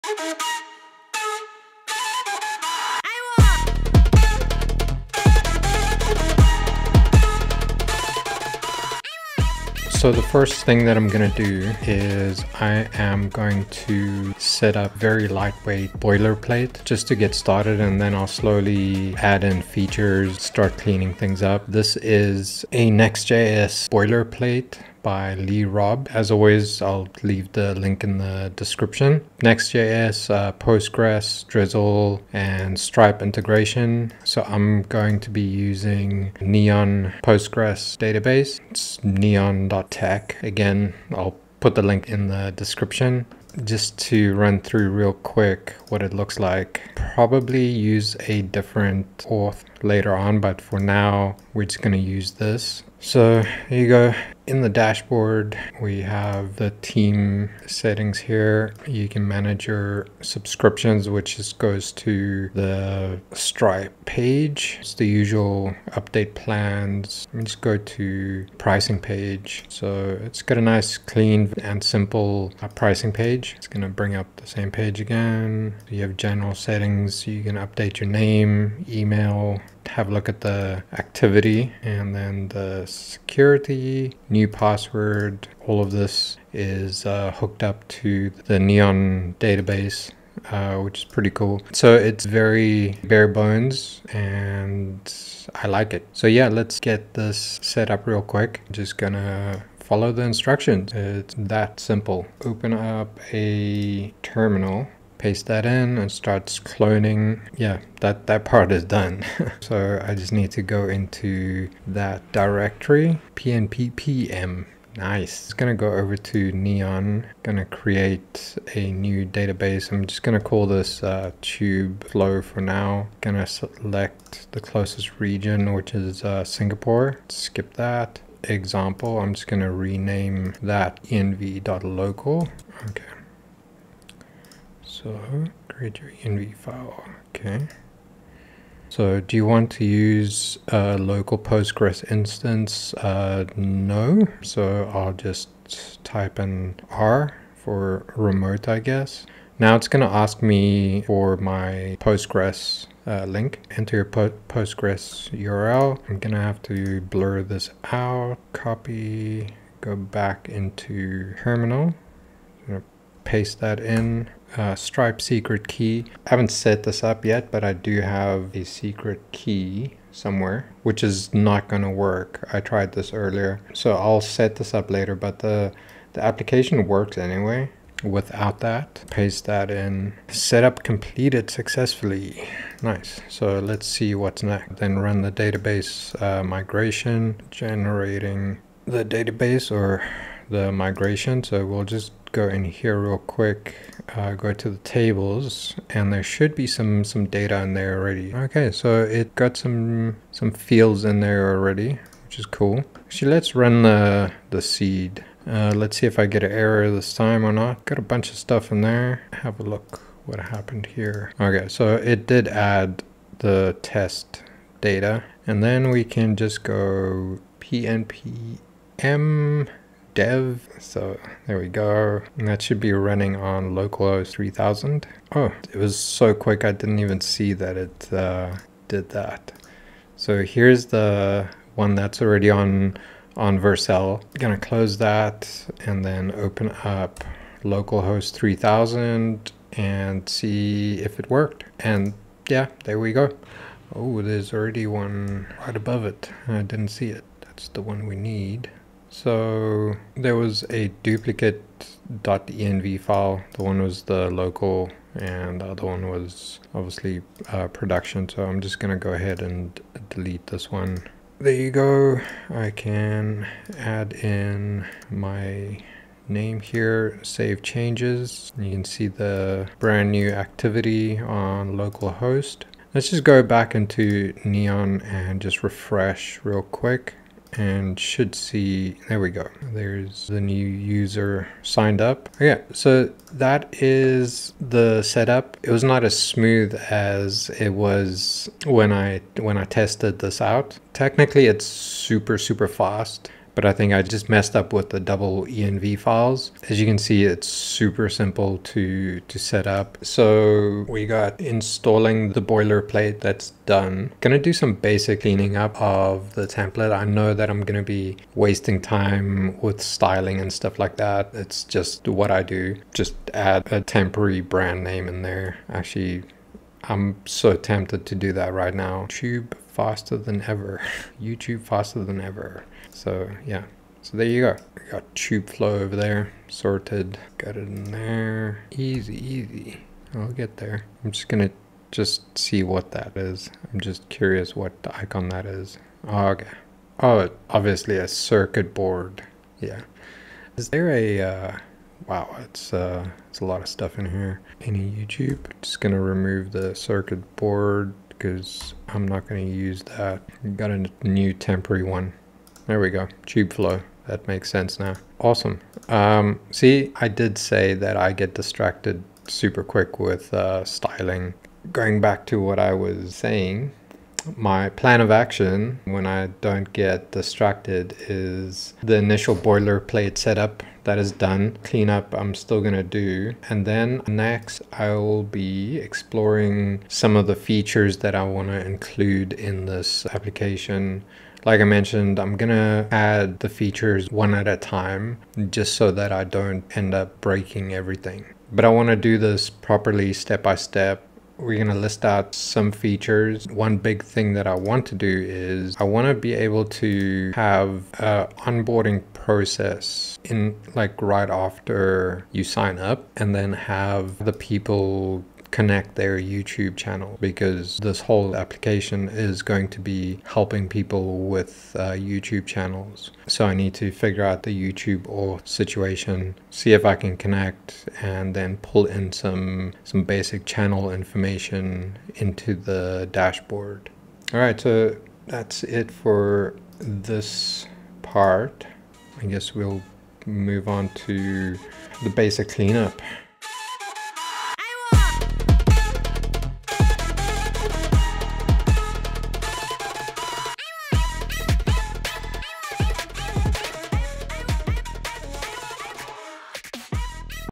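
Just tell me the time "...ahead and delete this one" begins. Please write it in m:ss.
4:19.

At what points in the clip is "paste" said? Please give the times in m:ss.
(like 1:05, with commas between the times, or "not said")
1:45, 2:43, 2:59.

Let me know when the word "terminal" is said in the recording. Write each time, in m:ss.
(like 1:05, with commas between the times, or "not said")
1:44, 2:41.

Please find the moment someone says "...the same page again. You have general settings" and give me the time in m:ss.
1:14.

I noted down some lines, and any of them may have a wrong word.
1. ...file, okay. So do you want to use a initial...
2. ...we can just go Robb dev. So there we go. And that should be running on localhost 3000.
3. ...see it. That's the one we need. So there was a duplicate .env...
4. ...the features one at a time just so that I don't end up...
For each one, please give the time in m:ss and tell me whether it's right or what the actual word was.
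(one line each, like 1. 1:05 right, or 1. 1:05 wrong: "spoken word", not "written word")
1. 2:16 wrong: "local", not "initial"
2. 3:35 wrong: "PNPM", not "Robb"
3. 4:06 right
4. 6:23 right.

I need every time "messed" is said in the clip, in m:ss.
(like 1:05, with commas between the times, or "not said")
4:54.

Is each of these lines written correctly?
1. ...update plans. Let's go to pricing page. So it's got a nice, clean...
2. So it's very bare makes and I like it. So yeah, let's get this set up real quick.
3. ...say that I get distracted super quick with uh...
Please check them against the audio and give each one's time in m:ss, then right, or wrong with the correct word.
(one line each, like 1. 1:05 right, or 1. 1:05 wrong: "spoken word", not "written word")
1. 1:05 right
2. 1:31 wrong: "bones", not "makes"
3. 5:57 right.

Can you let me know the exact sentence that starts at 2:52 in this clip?
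I tried this earlier, so I'll set this up later, but the, the application works anyway without that.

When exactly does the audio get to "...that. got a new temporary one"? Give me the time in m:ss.
5:49.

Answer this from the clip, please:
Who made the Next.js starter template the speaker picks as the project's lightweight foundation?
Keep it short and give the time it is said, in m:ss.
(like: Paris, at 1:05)
Lee Robb, at 0:25.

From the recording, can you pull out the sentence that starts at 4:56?
As you can see, it's super simple to, to set up.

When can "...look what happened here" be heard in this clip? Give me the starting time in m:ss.
3:29.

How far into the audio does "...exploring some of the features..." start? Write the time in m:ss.
6:15.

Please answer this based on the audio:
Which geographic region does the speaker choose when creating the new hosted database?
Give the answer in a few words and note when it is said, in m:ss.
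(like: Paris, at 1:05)
Singapore, at 2:06.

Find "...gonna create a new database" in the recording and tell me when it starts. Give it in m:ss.
1:57.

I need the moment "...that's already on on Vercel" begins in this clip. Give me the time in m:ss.
3:51.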